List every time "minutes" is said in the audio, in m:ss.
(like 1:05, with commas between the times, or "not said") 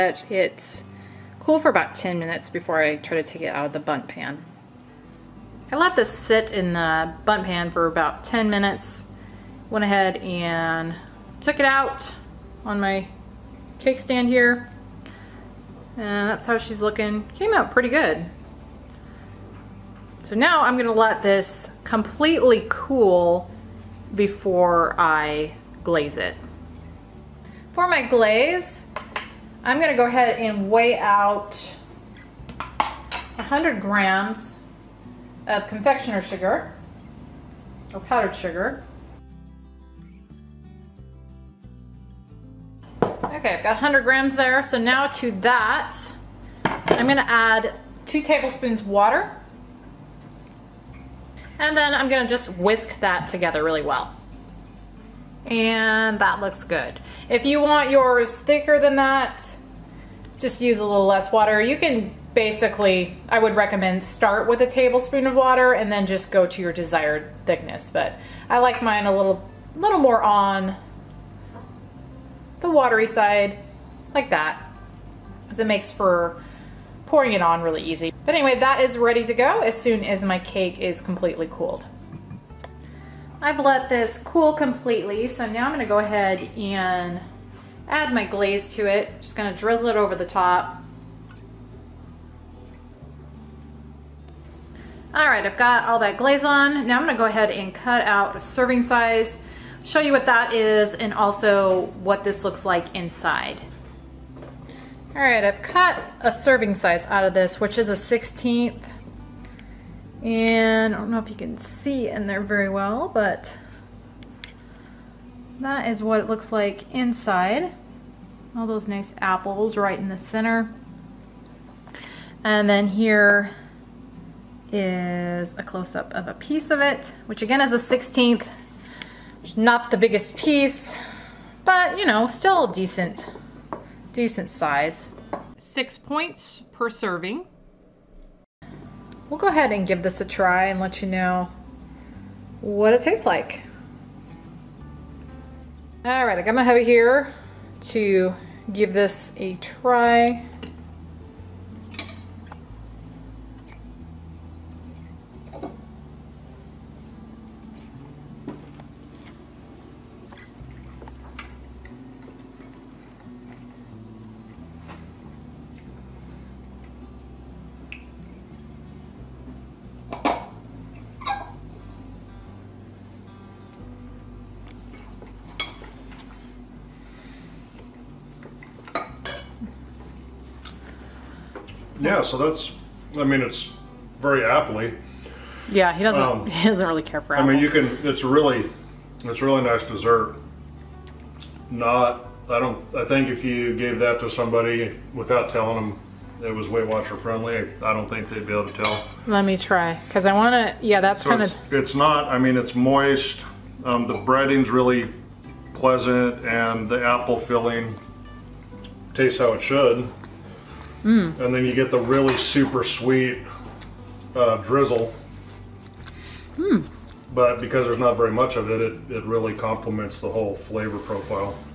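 0:02, 0:08.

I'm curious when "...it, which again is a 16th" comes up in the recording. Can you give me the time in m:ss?
2:06.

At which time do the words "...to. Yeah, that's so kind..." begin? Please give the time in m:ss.
3:20.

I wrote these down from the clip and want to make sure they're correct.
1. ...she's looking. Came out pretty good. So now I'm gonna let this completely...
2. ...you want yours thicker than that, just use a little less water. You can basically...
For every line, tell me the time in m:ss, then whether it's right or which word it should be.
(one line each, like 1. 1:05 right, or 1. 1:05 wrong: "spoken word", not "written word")
1. 0:16 right
2. 0:57 right.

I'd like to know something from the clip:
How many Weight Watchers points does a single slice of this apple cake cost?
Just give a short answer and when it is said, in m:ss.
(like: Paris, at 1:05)
6 points, at 2:15.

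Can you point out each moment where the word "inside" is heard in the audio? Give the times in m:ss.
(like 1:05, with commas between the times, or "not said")
1:42, 1:56.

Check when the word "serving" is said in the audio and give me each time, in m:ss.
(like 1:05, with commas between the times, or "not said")
1:38, 1:46, 2:16.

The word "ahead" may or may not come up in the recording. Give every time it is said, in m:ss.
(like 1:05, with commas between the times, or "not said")
0:09, 0:30, 1:25, 1:37, 2:19.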